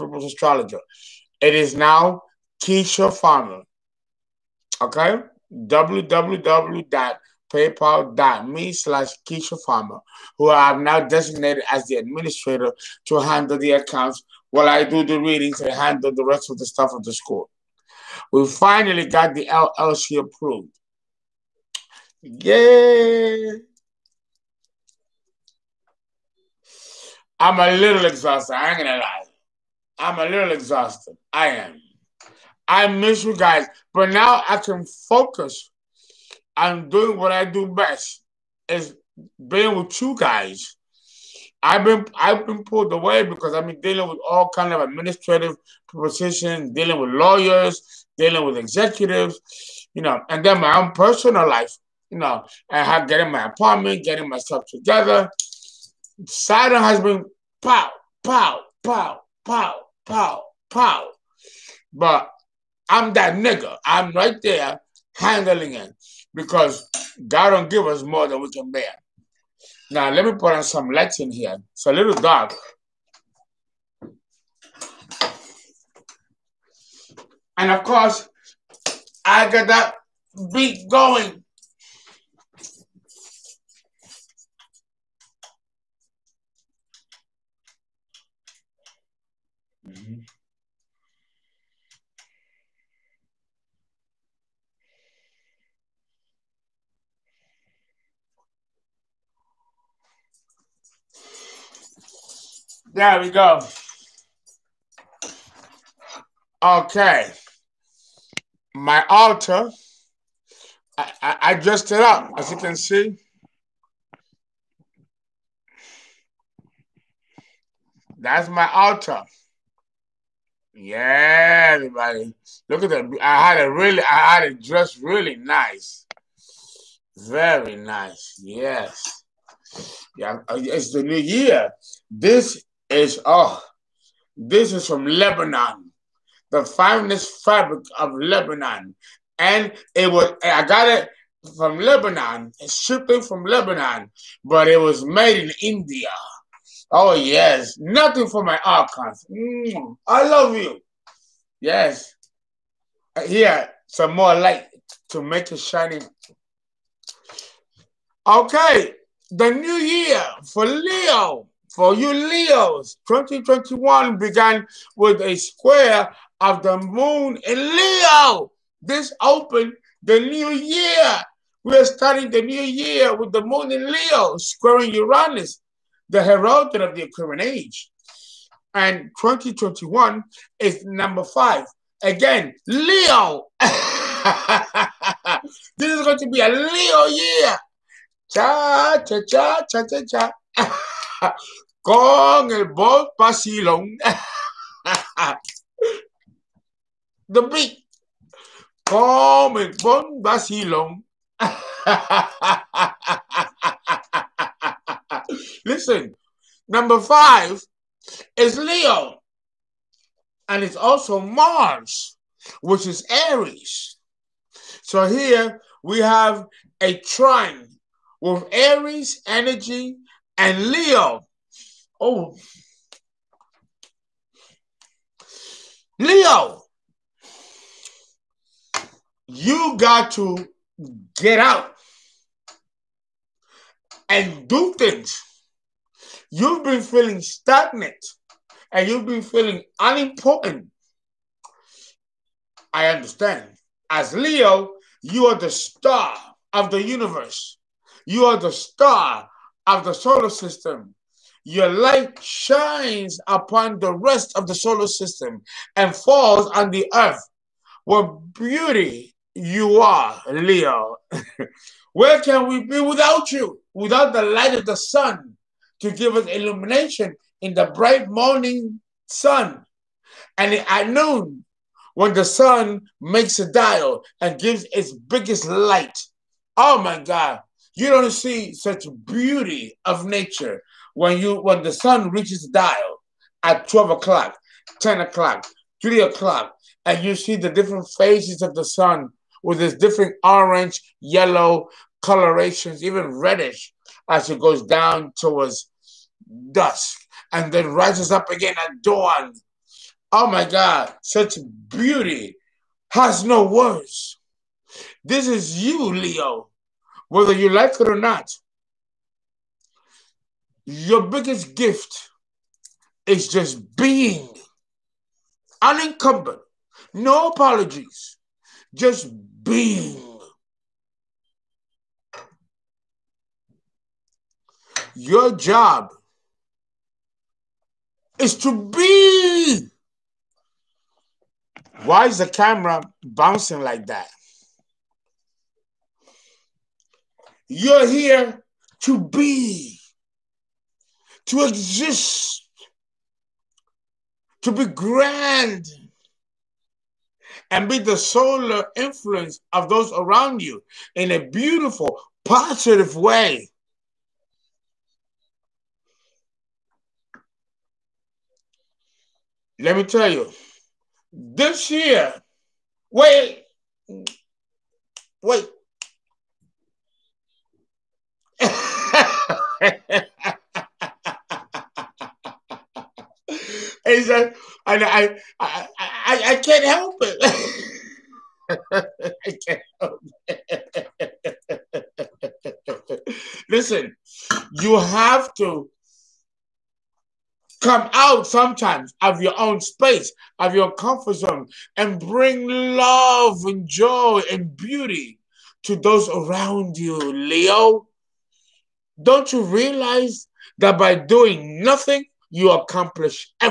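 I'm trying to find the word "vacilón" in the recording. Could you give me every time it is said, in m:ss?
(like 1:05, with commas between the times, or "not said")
3:13, 3:20.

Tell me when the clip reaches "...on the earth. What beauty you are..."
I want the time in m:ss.
4:16.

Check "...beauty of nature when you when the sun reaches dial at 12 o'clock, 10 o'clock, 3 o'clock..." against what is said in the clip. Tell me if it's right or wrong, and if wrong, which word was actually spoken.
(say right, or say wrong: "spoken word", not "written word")
right.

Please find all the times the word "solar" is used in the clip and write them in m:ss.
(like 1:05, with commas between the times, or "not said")
4:09, 4:14, 5:47.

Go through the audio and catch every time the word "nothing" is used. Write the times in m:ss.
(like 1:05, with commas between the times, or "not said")
2:27, 6:41.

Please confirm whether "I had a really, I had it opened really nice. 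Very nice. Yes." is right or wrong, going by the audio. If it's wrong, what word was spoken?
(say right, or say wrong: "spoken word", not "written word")
wrong: "dressed", not "opened".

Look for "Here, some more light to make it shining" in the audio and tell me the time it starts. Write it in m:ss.
2:33.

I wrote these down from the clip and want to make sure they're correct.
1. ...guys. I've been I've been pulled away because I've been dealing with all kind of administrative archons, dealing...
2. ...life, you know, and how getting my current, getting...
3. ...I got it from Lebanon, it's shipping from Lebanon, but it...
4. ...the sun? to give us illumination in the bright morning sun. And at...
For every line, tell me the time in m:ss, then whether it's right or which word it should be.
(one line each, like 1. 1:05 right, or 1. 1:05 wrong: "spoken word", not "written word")
1. 0:40 wrong: "positions", not "archons"
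2. 0:51 wrong: "apartment", not "current"
3. 2:20 right
4. 4:24 right.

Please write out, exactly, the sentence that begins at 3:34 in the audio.
So here we have a trine with Aries energy and Leo.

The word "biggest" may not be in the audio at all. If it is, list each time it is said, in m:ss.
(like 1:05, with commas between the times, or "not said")
4:34, 5:11.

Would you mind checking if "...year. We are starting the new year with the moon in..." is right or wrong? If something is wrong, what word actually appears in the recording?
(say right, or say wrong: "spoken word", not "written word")
right.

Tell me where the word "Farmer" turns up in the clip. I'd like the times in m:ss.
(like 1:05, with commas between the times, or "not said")
0:03, 0:09.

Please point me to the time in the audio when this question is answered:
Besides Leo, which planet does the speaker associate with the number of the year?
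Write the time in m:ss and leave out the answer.
3:31.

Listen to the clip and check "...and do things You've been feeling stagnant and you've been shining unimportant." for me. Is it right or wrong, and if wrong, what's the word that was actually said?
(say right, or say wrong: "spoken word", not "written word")
wrong: "feeling", not "shining".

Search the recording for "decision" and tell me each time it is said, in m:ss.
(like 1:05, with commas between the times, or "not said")
not said.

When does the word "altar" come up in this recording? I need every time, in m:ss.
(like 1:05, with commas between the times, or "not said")
1:49, 1:58.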